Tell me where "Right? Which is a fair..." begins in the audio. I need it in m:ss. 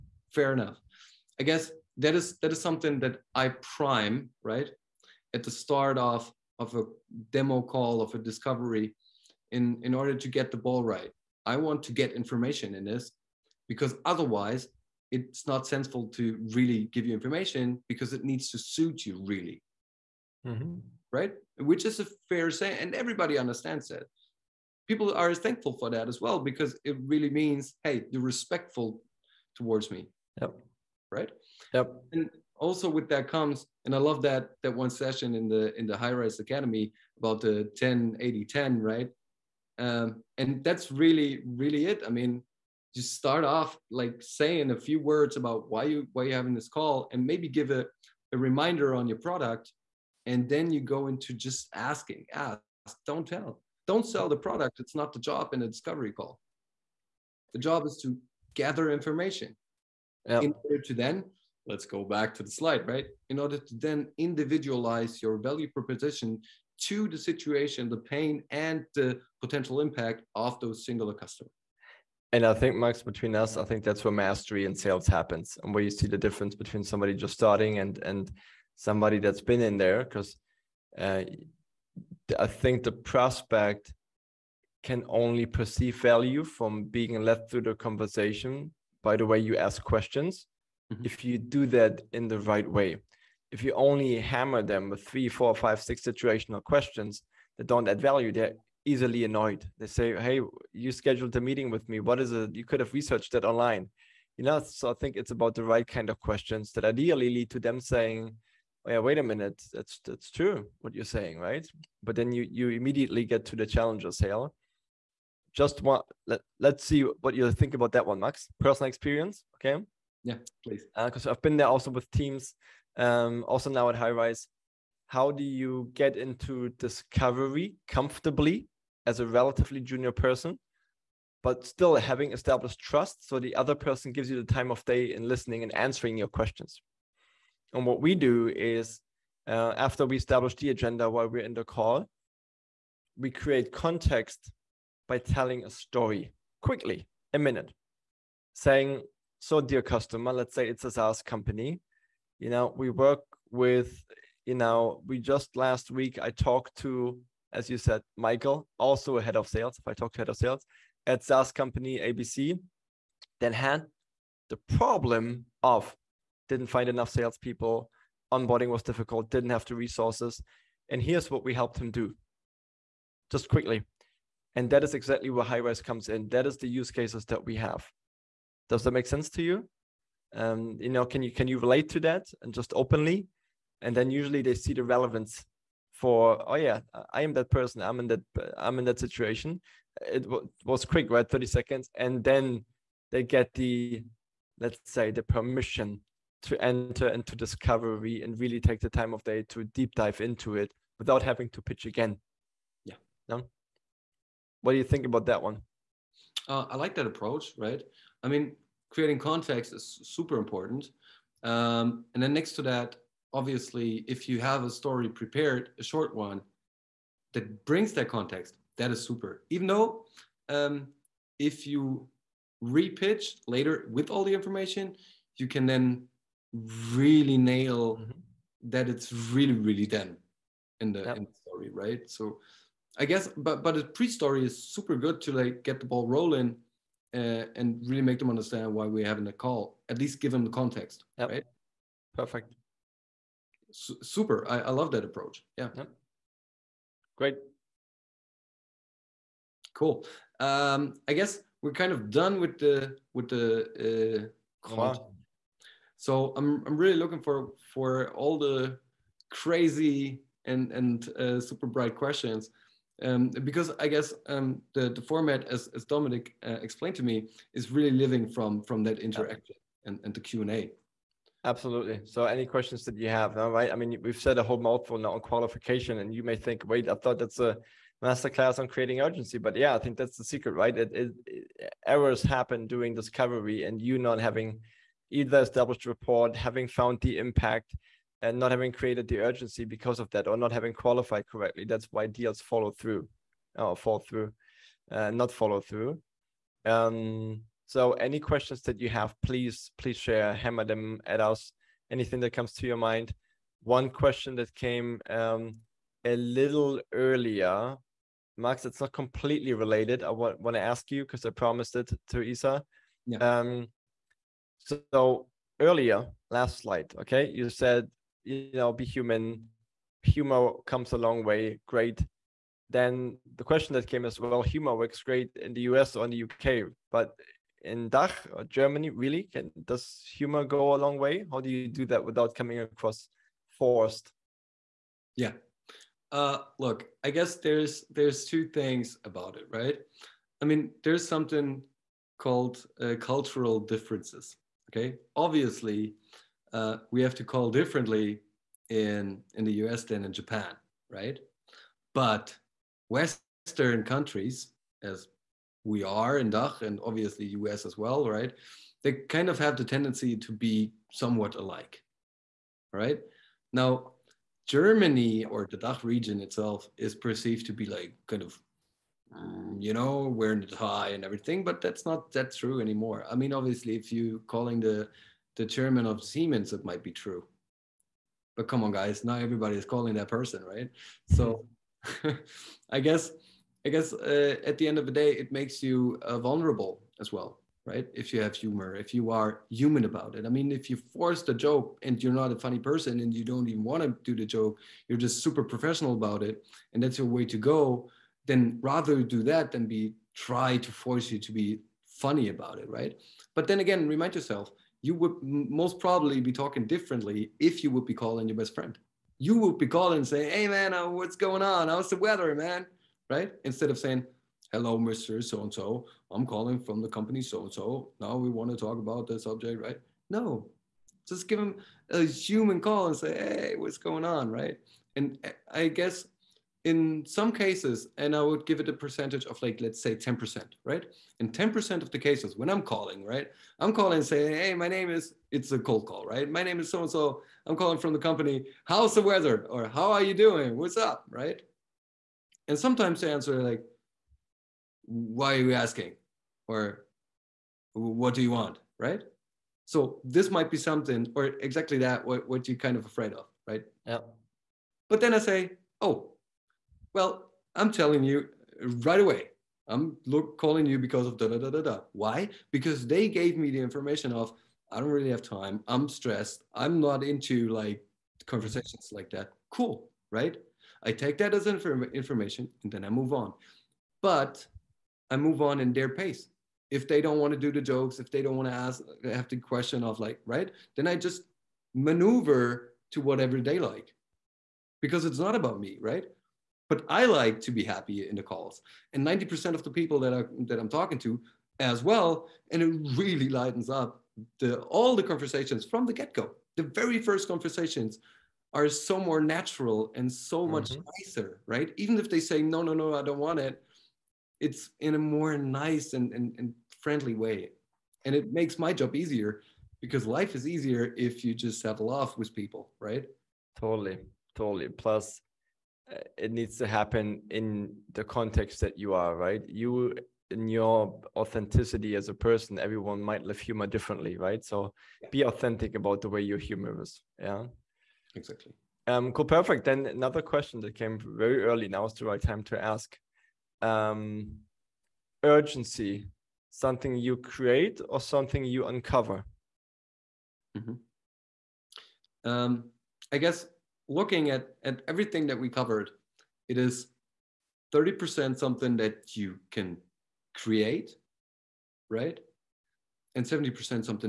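0:21.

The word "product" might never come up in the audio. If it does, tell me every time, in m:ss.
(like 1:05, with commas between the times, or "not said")
0:49, 0:54.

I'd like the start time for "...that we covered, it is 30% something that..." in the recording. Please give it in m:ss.
9:05.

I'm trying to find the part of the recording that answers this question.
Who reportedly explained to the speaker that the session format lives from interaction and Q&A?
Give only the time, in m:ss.
4:25.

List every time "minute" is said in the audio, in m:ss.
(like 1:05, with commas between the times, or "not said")
1:49, 2:27.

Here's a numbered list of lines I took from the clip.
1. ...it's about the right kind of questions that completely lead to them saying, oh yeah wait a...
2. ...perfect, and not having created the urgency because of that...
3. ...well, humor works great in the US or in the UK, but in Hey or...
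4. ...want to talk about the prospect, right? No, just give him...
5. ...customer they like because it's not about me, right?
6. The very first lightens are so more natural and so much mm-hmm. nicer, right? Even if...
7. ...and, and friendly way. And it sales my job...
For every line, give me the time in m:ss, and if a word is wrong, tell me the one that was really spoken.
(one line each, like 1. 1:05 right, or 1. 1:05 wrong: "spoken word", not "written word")
1. 1:45 wrong: "ideally", not "completely"
2. 4:47 wrong: "impact", not "perfect"
3. 5:24 wrong: "DACH", not "Hey"
4. 6:58 wrong: "subject", not "prospect"
5. 8:02 wrong: "whatever", not "customer"
6. 8:16 wrong: "conversations", not "lightens"
7. 8:26 wrong: "makes", not "sales".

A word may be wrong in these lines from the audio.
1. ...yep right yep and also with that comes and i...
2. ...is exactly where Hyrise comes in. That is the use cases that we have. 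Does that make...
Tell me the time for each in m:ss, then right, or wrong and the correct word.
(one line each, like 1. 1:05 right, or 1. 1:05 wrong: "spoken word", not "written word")
1. 0:30 right
2. 2:54 right.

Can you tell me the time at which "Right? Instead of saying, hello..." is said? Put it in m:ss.
6:53.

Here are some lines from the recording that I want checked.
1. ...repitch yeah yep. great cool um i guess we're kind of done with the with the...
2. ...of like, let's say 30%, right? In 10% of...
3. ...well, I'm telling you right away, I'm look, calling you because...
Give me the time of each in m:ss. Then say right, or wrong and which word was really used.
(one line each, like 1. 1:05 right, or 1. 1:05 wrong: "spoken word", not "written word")
1. 4:05 wrong: "approach", not "repitch"
2. 7:09 wrong: "10", not "30"
3. 7:36 right.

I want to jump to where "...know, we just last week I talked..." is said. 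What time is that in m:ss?
2:34.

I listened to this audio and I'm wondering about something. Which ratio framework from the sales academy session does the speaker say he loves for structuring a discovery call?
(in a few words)
10 80 10.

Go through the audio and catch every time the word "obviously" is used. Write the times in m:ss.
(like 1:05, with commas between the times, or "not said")
3:33, 5:45, 5:56, 6:13.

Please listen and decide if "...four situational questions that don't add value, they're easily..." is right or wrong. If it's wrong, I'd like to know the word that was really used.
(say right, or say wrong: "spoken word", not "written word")
wrong: "six", not "four".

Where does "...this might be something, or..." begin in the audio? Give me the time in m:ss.
7:30.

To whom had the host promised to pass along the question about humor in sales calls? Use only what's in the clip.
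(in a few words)
Isa.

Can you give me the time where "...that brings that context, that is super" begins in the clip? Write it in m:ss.
3:37.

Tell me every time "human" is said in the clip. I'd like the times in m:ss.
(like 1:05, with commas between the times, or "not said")
5:18, 6:29, 7:02.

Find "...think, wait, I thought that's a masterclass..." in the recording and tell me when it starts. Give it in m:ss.
4:36.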